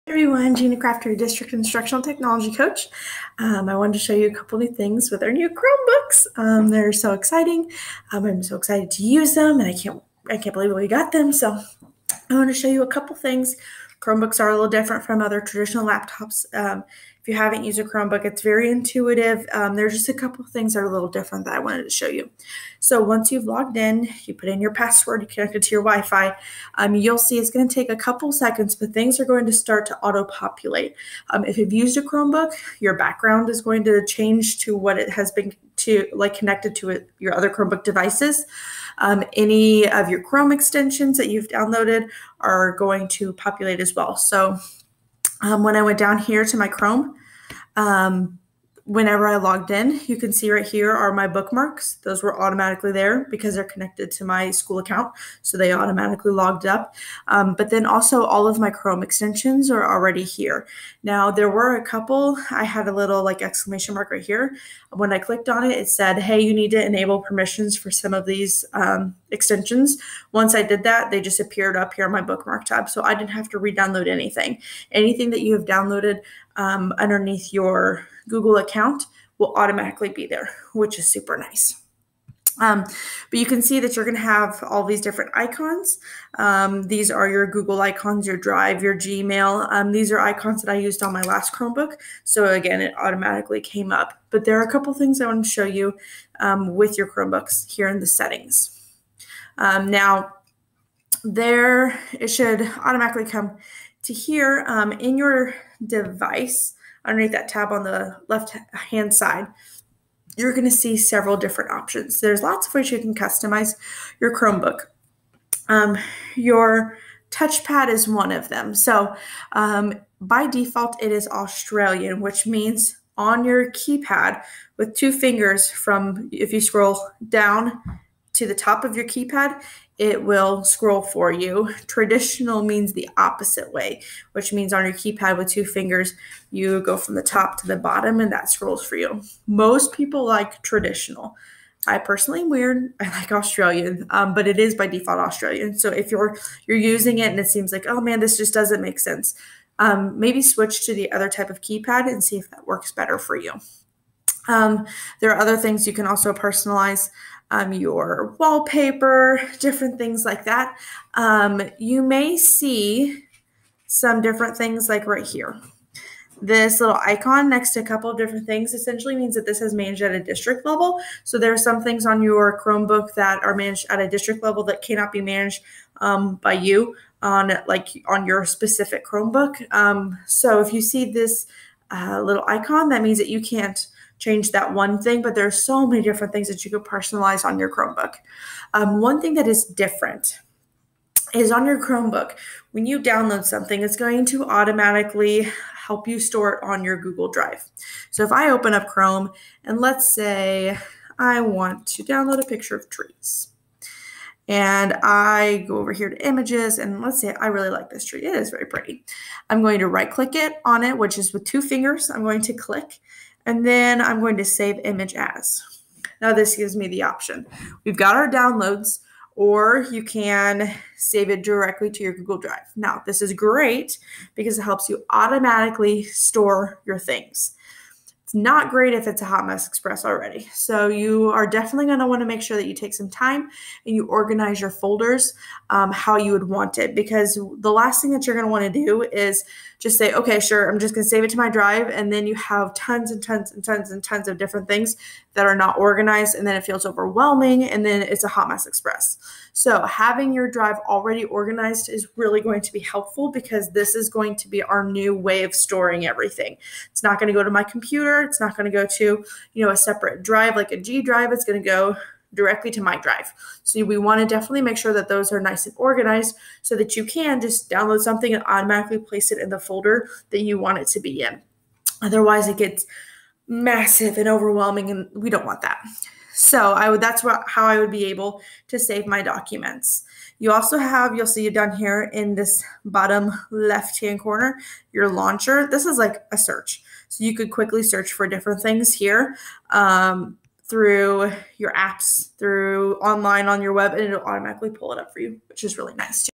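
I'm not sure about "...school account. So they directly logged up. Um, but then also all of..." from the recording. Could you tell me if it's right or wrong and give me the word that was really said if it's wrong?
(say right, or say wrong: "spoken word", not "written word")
wrong: "automatically", not "directly".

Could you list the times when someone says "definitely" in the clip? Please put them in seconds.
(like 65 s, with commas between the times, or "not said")
231 s, 264 s.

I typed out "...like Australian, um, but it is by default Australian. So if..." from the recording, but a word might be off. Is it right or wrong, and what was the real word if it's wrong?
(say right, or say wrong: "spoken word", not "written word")
right.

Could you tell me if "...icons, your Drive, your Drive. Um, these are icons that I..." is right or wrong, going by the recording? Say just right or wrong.
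wrong.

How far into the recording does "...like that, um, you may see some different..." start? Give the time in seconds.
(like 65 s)
160 s.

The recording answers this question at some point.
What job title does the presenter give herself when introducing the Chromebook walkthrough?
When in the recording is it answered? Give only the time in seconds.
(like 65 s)
1 s.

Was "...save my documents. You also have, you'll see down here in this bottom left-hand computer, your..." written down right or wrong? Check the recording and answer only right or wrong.
wrong.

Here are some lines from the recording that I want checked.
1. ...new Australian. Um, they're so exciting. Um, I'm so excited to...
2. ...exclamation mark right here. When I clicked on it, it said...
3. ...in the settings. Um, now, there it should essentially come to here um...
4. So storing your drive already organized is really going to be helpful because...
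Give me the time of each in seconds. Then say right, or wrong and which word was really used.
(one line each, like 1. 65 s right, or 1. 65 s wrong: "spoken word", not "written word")
1. 5 s wrong: "Chromebooks", not "Australian"
2. 63 s right
3. 97 s wrong: "automatically", not "essentially"
4. 249 s wrong: "having", not "storing".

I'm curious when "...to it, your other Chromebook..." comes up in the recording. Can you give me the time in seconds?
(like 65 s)
36 s.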